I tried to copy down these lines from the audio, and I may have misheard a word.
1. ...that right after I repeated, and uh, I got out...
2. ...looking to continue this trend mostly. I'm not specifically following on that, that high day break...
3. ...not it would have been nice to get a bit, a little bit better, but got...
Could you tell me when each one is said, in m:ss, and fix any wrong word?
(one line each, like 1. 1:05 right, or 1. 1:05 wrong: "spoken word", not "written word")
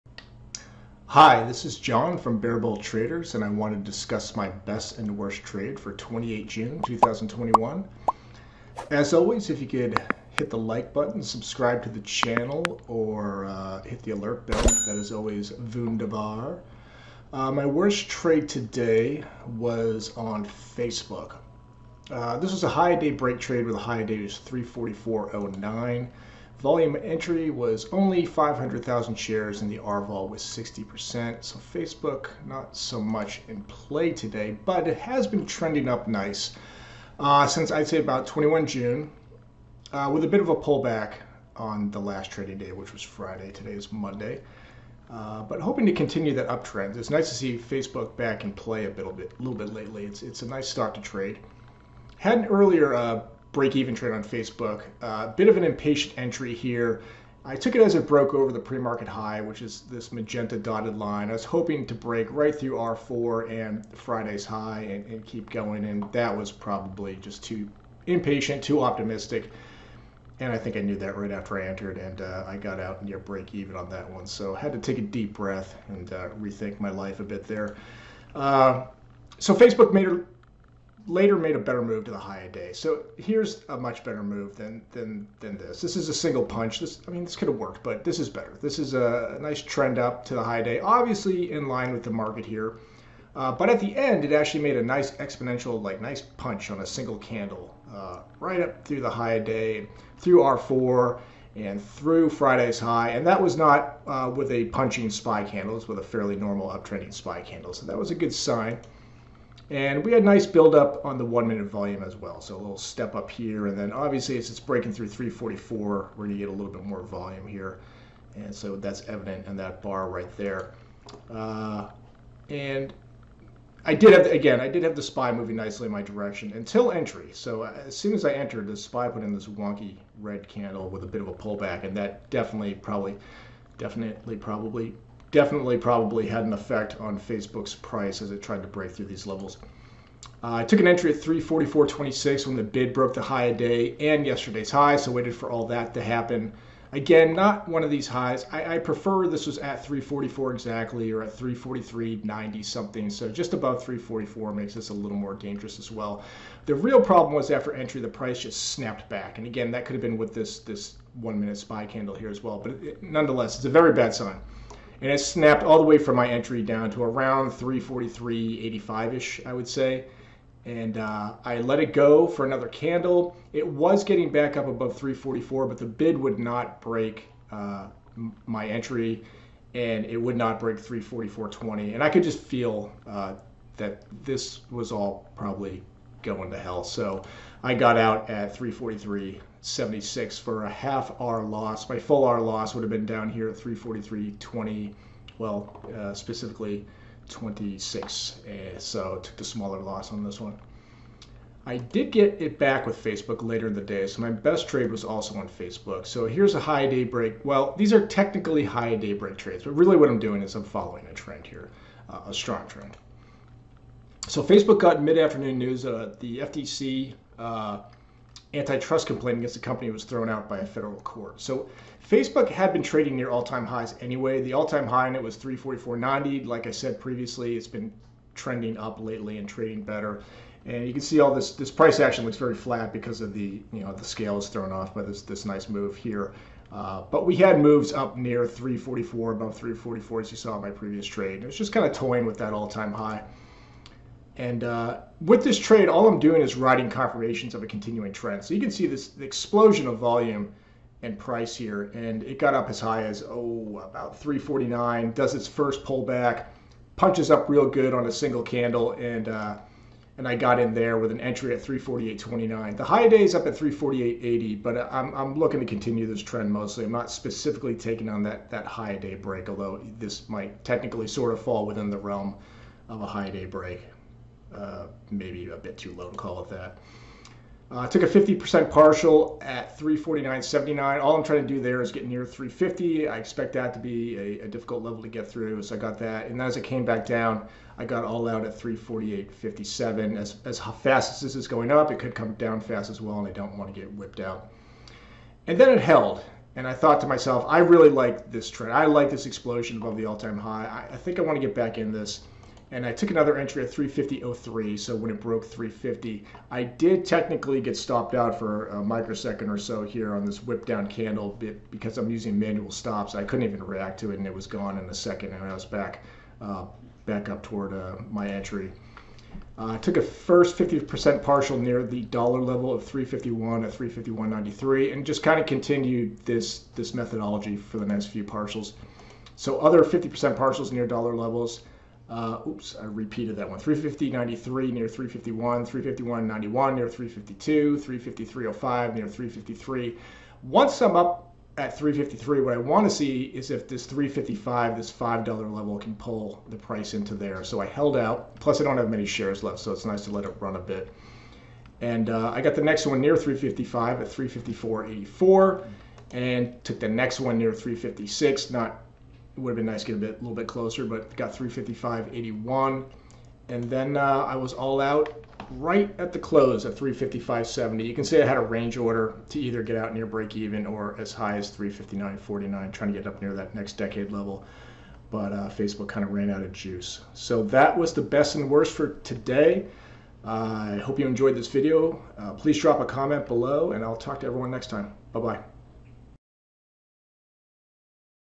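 1. 1:10 wrong: "entered", not "repeated"
2. 4:25 wrong: "taking", not "following"
3. 5:58 wrong: "closer", not "better".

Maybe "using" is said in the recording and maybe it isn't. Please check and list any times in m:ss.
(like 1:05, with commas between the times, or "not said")
5:12.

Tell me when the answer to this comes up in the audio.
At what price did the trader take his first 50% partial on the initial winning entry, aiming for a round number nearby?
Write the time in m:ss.
4:39.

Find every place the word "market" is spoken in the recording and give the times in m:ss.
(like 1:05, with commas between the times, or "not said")
0:58, 1:32.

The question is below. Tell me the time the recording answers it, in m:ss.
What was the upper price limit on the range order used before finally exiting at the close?
6:11.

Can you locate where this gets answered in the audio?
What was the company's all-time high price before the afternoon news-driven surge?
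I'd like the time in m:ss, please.
3:45.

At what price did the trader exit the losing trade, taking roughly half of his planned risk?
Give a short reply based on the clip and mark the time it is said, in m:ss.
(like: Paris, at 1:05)
343.76, at 3:08.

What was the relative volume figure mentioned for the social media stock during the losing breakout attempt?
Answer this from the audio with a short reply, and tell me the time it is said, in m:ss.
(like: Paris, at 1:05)
60%, at 0:30.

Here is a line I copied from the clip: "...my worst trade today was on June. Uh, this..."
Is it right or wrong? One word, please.
wrong.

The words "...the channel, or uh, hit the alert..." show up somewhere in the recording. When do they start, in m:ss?
0:11.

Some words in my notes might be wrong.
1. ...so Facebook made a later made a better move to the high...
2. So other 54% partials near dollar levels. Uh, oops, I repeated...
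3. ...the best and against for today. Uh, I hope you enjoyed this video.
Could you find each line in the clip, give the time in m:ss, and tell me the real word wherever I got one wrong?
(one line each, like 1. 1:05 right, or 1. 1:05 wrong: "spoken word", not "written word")
1. 1:19 right
2. 5:29 wrong: "50", not "54"
3. 6:17 wrong: "worst", not "against".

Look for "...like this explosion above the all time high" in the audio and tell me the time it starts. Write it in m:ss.
4:58.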